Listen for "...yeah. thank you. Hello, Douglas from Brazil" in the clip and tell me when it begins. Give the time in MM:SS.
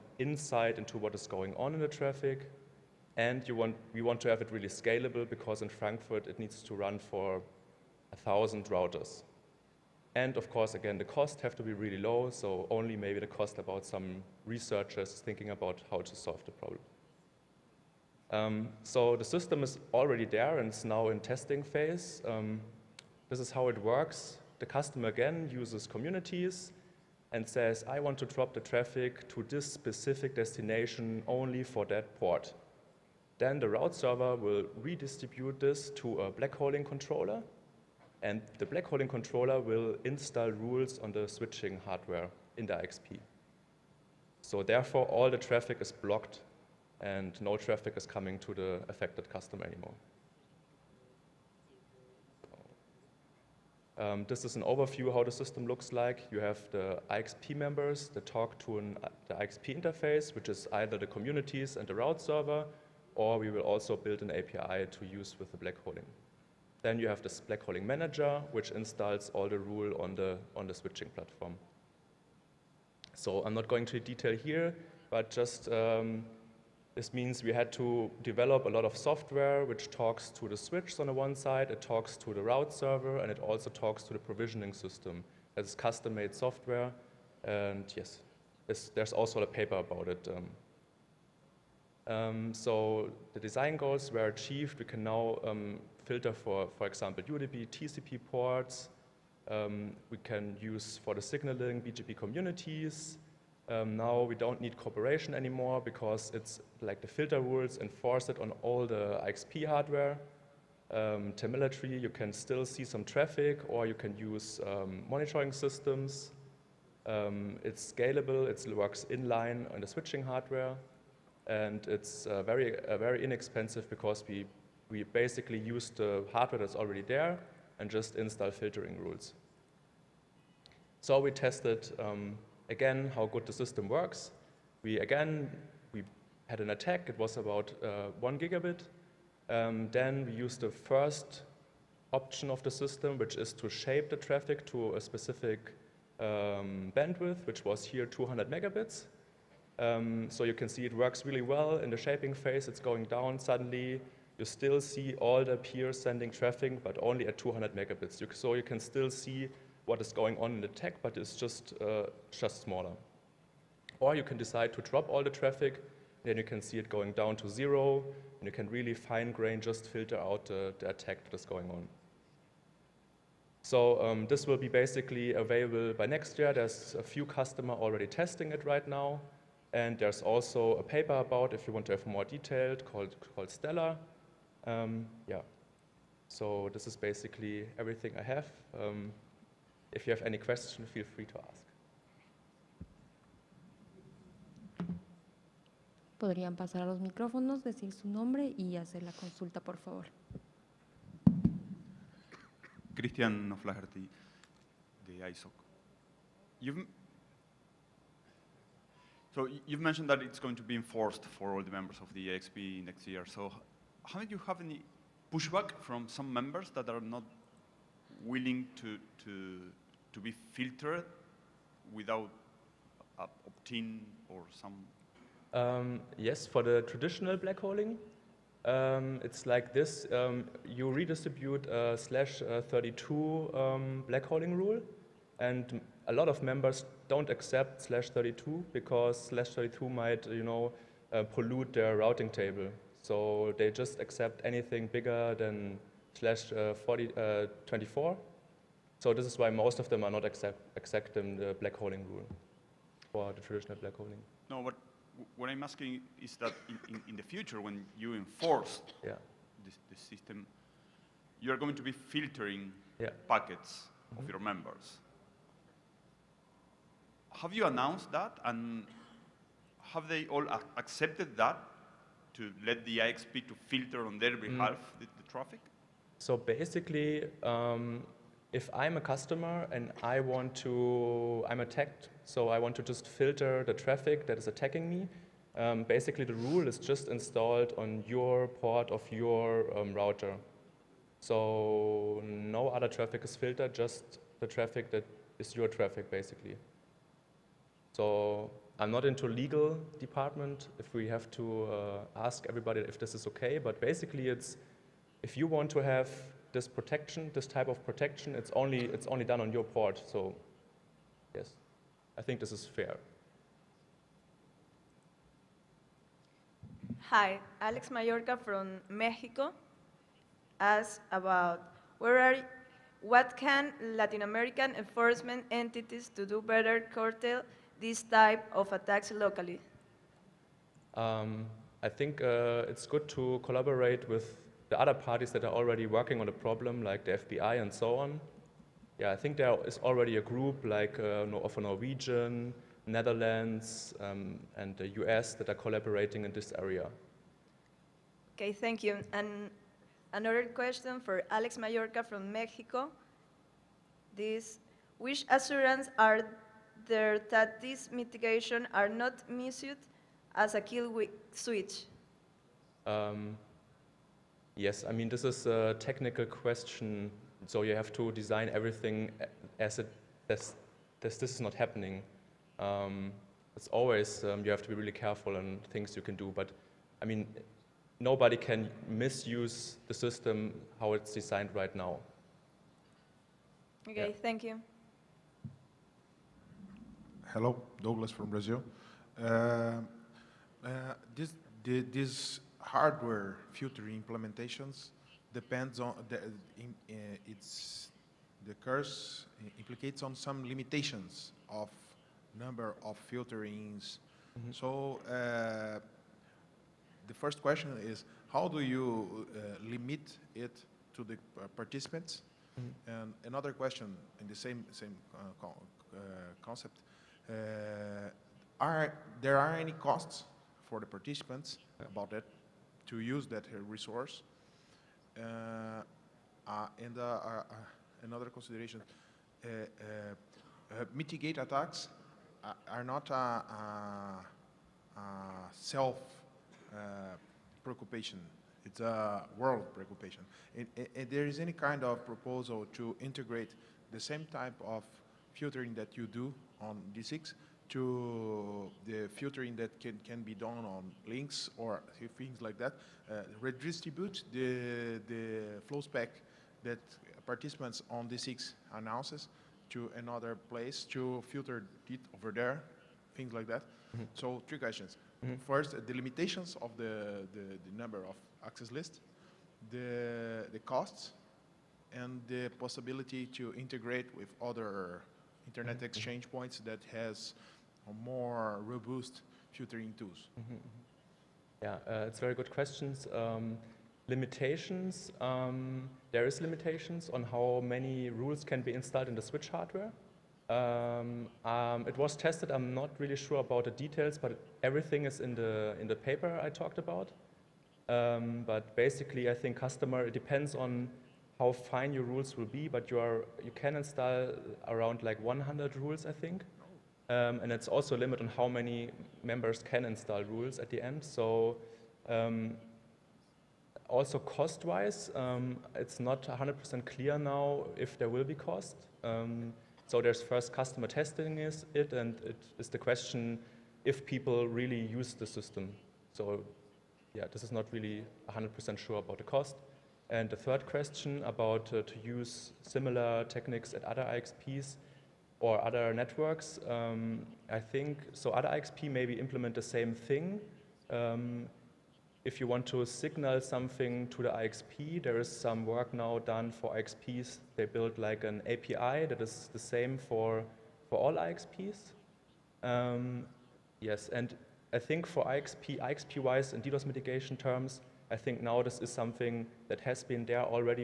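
06:24.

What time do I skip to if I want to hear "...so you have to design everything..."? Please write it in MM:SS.
06:07.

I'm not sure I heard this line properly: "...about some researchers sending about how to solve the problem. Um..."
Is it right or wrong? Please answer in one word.
wrong.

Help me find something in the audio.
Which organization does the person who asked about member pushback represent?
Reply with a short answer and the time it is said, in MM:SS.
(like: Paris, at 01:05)
ISOC, at 03:25.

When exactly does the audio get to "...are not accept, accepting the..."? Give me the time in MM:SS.
04:10.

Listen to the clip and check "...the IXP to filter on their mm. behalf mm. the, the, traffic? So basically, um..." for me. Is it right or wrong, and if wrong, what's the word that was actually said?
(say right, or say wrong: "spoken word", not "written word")
right.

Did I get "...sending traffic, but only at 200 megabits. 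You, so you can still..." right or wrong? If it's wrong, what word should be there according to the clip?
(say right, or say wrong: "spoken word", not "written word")
right.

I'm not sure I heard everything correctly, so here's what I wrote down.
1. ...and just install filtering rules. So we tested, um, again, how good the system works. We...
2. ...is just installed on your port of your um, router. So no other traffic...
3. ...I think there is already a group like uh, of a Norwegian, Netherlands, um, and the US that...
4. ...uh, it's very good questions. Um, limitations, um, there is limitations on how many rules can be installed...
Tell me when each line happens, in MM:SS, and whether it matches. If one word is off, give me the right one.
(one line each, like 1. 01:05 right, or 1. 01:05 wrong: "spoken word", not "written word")
1. 02:07 right
2. 04:46 right
3. 05:39 right
4. 08:01 right.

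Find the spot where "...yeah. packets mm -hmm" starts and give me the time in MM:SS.
04:22.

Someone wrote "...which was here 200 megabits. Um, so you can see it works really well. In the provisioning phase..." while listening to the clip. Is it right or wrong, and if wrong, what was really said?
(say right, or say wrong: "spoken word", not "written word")
wrong: "shaping", not "provisioning".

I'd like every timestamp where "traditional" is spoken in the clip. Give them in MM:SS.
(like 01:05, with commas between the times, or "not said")
03:46, 04:13.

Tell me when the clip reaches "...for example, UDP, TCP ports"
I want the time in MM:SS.
01:36.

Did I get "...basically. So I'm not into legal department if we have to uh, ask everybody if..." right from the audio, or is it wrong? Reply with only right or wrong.
right.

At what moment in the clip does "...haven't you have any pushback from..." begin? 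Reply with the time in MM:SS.
03:34.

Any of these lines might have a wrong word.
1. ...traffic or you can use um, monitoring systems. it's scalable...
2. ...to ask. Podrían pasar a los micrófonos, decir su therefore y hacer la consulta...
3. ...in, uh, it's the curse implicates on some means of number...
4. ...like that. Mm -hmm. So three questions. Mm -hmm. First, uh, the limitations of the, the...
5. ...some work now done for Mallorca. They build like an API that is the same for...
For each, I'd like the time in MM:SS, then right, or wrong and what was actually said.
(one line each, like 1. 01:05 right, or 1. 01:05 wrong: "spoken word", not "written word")
1. 01:53 right
2. 03:11 wrong: "nombre", not "therefore"
3. 06:36 wrong: "limitations", not "means"
4. 07:43 right
5. 09:05 wrong: "IXPs", not "Mallorca".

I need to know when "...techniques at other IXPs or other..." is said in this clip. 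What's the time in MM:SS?
08:53.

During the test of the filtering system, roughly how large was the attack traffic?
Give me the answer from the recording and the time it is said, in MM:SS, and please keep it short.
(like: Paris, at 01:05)
1 gigabit, at 02:18.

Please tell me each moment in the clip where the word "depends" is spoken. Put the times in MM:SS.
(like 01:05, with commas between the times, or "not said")
06:35, 08:20.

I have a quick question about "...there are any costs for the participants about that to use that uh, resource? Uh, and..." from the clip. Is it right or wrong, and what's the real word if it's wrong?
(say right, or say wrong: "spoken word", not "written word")
right.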